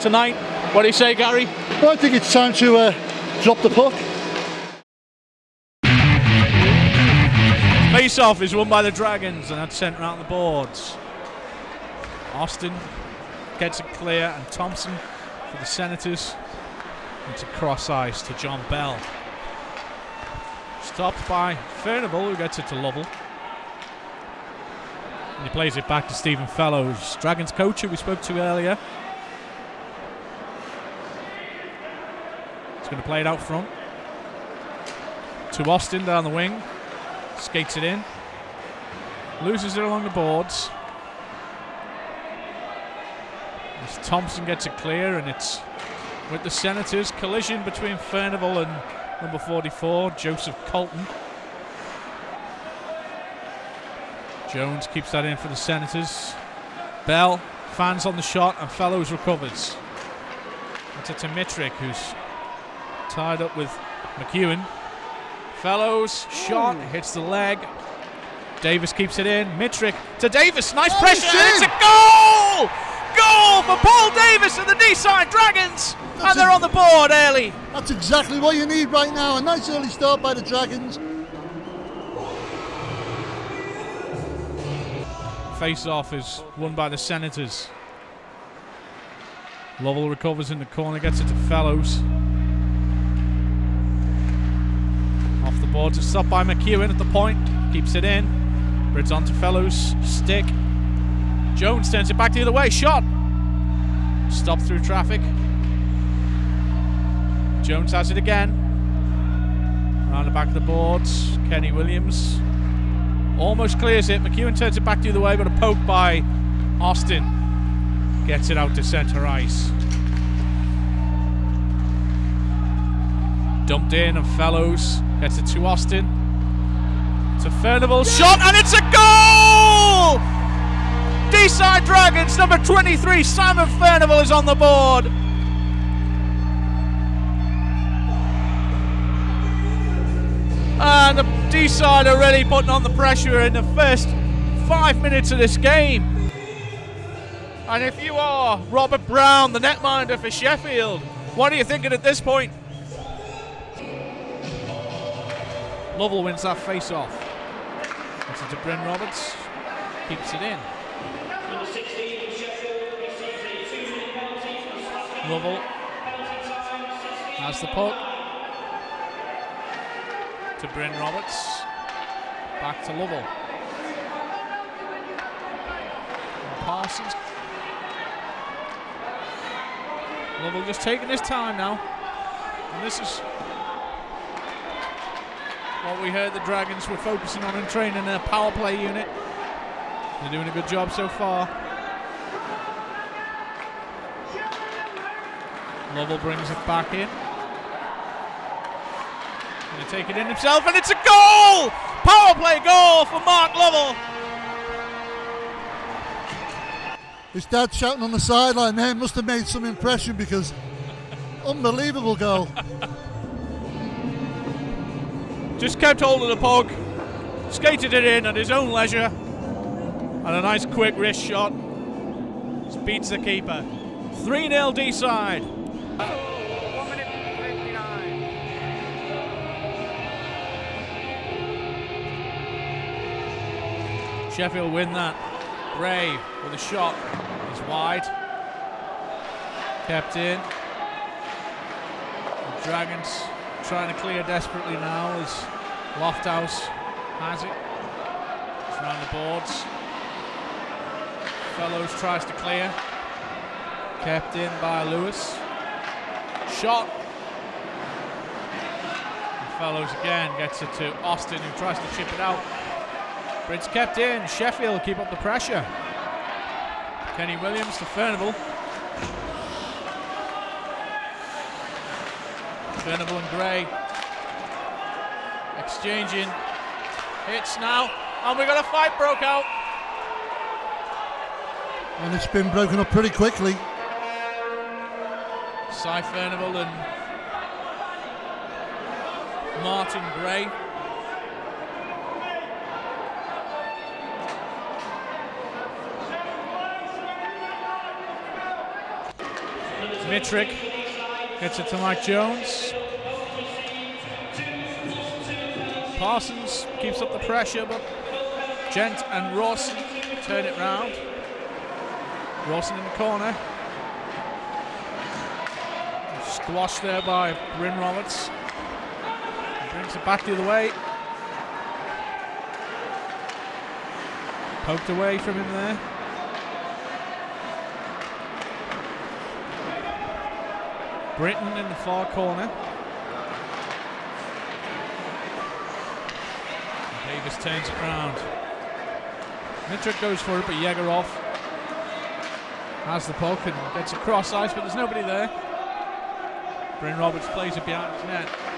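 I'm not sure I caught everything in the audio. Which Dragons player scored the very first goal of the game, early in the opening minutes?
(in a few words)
Paul Davis.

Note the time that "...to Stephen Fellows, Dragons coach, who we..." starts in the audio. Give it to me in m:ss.
0:26.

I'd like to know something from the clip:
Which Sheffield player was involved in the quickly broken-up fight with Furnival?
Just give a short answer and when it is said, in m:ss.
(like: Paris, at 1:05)
Martin Gray, at 4:49.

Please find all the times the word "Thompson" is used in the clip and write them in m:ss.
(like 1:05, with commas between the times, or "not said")
0:14, 0:44.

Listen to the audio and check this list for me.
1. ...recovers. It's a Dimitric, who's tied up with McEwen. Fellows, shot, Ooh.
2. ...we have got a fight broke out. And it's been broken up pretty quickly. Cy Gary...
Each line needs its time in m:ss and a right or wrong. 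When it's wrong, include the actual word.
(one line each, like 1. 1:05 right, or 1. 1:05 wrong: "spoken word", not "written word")
1. 0:59 right
2. 4:38 wrong: "Furnival", not "Gary".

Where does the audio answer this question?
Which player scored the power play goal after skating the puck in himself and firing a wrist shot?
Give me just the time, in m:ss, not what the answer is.
3:23.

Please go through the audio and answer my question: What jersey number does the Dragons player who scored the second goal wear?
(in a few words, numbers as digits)
23.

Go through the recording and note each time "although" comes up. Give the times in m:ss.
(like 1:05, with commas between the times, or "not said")
not said.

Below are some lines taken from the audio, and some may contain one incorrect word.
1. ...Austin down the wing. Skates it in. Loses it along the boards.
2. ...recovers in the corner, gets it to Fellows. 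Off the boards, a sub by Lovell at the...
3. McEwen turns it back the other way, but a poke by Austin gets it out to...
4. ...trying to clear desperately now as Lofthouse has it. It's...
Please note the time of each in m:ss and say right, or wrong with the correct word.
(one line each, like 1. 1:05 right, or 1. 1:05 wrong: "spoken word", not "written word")
1. 0:35 right
2. 1:30 wrong: "McEwen", not "Lovell"
3. 1:54 right
4. 4:03 right.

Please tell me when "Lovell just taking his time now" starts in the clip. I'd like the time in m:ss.
3:00.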